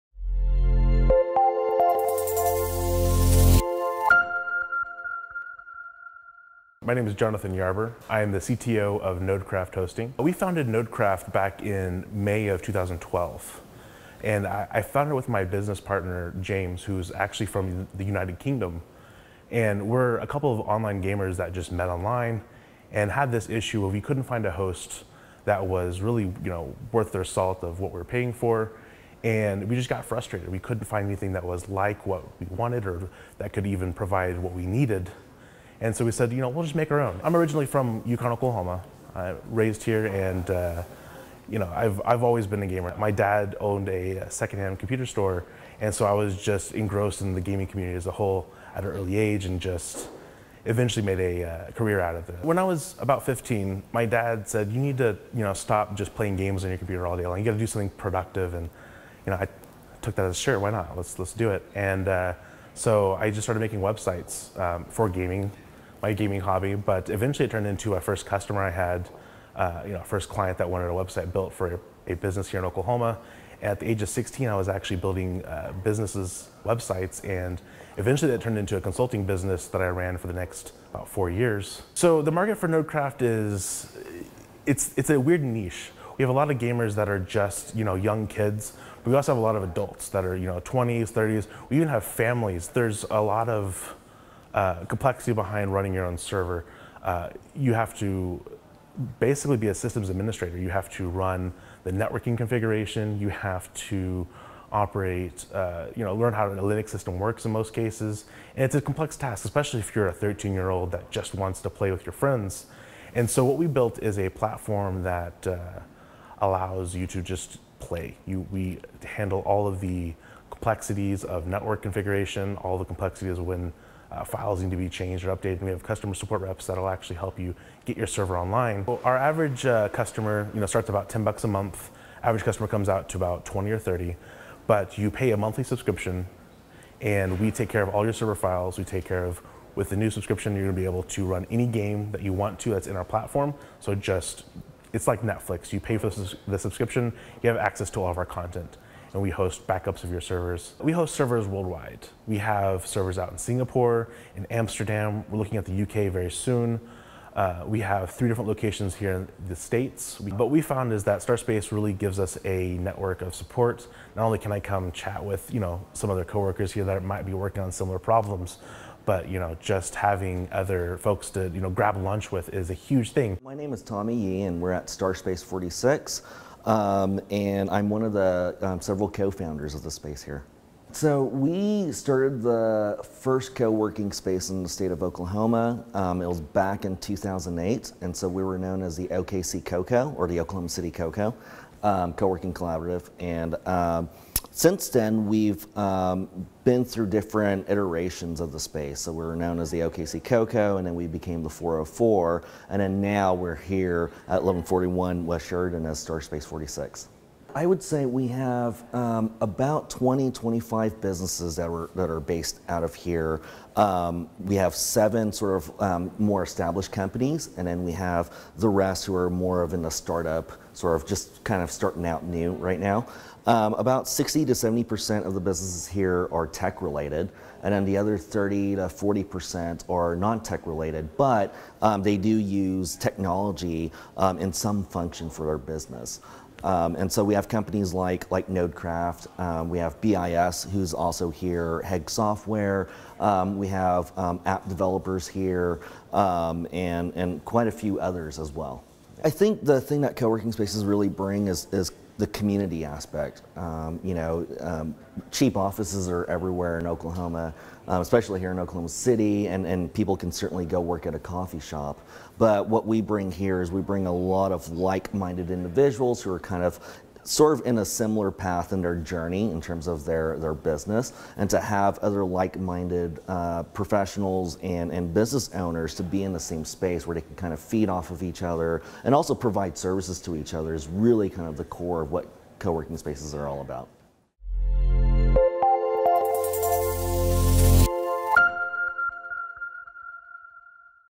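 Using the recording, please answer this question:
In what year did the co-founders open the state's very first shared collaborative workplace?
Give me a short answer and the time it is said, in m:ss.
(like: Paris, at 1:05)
2008, at 3:06.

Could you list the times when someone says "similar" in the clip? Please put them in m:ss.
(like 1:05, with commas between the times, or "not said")
2:47, 4:27.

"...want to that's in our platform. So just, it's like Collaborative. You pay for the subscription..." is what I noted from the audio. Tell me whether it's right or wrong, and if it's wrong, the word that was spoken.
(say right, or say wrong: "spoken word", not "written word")
wrong: "Netflix", not "Collaborative".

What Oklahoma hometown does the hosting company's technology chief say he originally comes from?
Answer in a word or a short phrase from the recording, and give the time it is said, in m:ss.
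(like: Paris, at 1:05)
Yukon, Oklahoma, at 0:38.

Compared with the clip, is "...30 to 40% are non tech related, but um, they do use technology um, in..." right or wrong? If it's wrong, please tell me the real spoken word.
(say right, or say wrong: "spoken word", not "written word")
right.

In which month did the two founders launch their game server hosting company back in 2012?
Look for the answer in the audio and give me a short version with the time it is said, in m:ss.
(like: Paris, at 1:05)
May, at 0:12.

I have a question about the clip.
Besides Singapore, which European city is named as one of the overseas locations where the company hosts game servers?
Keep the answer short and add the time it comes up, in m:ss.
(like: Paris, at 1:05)
Amsterdam, at 2:34.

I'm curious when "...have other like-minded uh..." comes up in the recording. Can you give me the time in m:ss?
4:31.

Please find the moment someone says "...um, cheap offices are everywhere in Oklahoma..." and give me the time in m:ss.
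4:14.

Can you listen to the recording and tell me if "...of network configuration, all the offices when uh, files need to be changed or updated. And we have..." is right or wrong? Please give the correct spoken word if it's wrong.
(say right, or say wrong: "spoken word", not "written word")
wrong: "complexities", not "offices".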